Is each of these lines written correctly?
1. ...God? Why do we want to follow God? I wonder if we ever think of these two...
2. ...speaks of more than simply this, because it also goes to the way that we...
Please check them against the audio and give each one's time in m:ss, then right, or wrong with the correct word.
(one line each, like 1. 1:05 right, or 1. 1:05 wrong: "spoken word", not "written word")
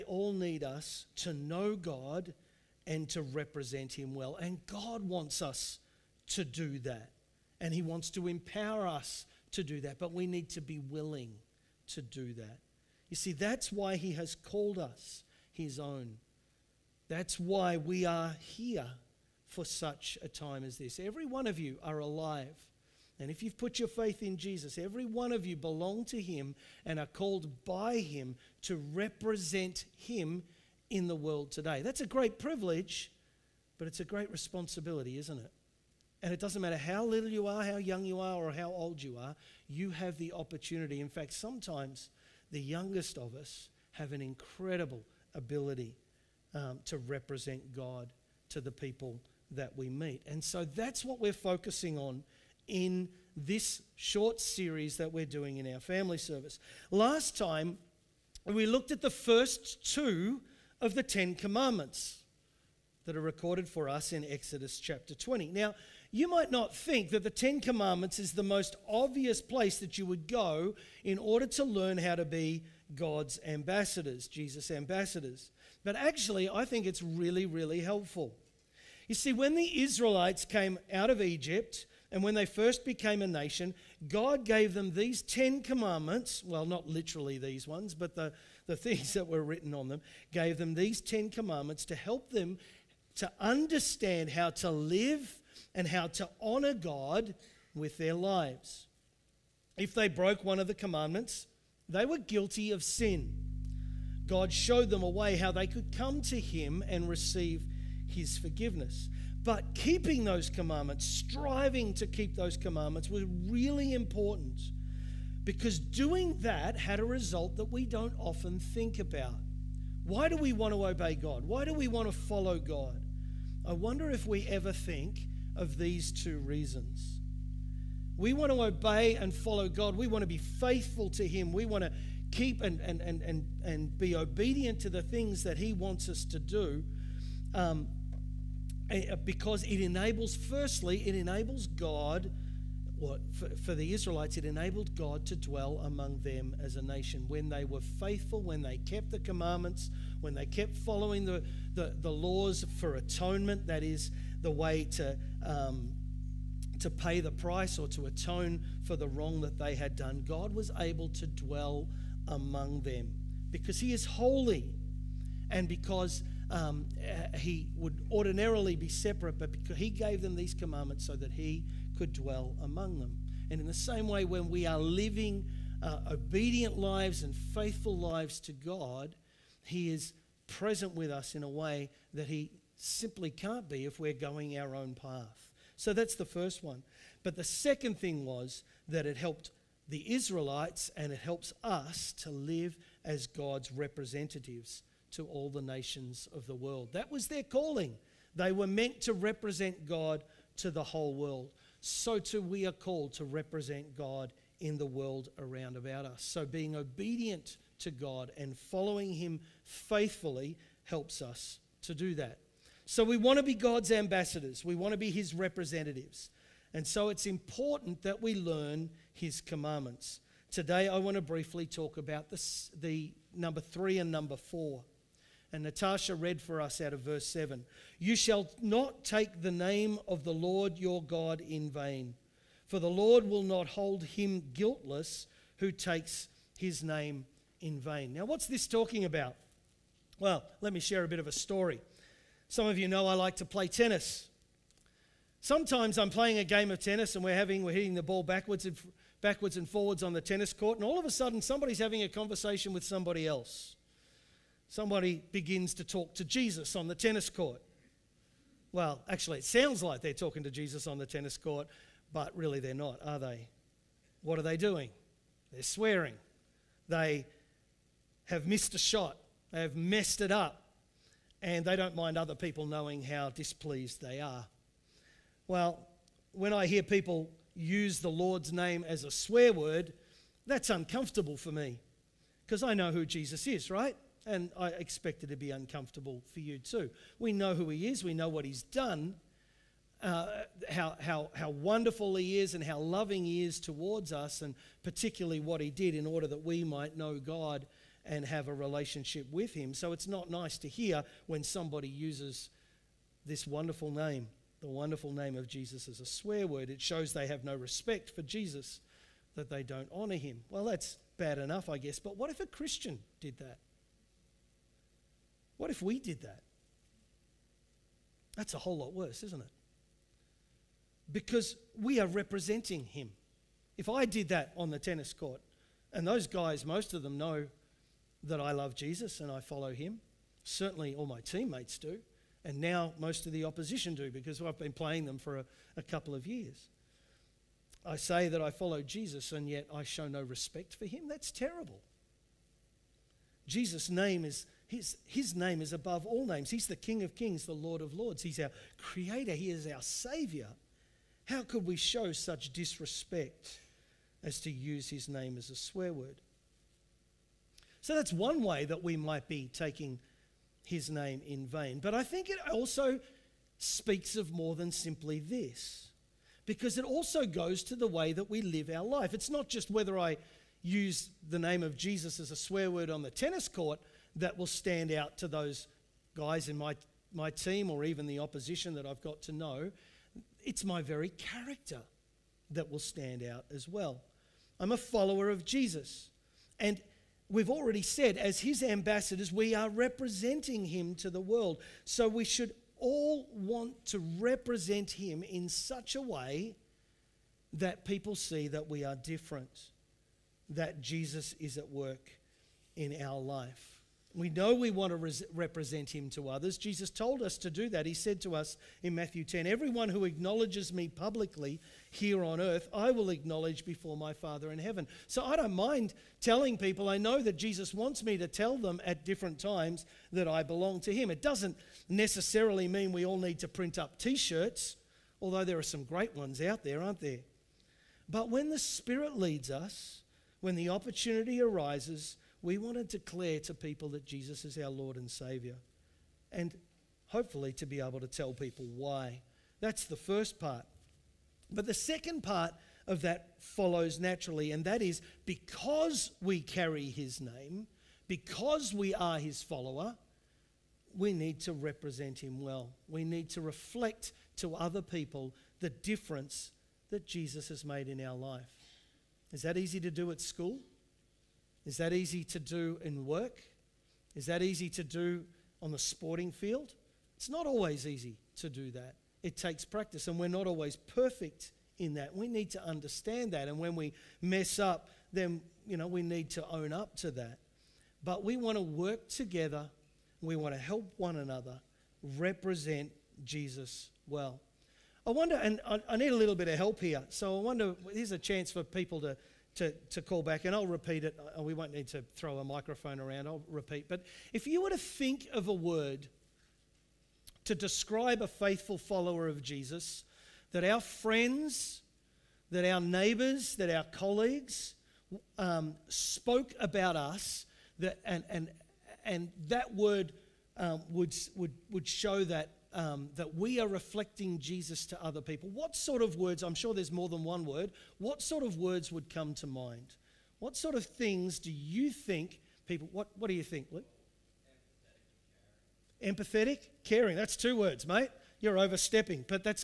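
1. 2:01 right
2. 6:03 right.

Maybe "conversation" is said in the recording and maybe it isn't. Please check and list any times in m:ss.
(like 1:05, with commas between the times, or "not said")
4:12.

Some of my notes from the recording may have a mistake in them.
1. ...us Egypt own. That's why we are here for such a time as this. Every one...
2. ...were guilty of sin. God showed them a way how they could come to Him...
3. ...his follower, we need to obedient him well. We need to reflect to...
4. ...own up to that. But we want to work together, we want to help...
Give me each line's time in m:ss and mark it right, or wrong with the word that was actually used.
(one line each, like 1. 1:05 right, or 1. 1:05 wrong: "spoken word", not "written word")
1. 0:14 wrong: "His", not "Egypt"
2. 1:42 right
3. 7:29 wrong: "represent", not "obedient"
4. 7:56 right.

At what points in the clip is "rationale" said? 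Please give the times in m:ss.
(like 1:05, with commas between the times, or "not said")
not said.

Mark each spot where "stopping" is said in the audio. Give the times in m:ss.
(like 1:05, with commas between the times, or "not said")
not said.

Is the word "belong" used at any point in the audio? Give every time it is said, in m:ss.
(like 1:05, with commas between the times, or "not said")
0:25, 7:00.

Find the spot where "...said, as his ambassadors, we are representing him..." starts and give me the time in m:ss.
6:27.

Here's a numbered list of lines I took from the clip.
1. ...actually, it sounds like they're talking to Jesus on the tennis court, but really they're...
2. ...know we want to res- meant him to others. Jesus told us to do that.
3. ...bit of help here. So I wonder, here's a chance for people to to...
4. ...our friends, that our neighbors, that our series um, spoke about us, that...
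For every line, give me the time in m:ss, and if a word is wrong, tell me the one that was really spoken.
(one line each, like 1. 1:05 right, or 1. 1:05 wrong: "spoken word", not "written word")
1. 4:19 right
2. 6:44 wrong: "represent", not "meant"
3. 8:06 right
4. 8:20 wrong: "colleagues", not "series".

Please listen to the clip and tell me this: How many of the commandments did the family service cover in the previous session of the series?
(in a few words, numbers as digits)
2.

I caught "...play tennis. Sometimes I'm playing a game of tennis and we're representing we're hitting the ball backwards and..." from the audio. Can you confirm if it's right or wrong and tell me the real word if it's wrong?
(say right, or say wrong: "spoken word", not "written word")
wrong: "having", not "representing".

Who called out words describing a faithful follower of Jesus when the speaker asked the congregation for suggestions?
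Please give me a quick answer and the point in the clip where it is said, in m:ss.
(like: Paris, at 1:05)
Luke, at 8:43.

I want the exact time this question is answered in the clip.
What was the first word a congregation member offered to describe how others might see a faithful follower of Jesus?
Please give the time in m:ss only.
8:46.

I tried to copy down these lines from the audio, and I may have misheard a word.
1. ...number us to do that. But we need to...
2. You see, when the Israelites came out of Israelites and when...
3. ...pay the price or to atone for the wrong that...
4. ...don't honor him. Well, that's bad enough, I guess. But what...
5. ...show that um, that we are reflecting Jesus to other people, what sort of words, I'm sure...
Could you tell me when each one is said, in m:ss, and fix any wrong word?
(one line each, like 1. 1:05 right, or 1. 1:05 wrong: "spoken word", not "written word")
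1. 0:08 wrong: "empower", not "number"
2. 1:19 wrong: "Egypt", not "Israelites"
3. 2:36 right
4. 5:09 right
5. 8:31 right.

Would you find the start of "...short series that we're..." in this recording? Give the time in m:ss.
0:53.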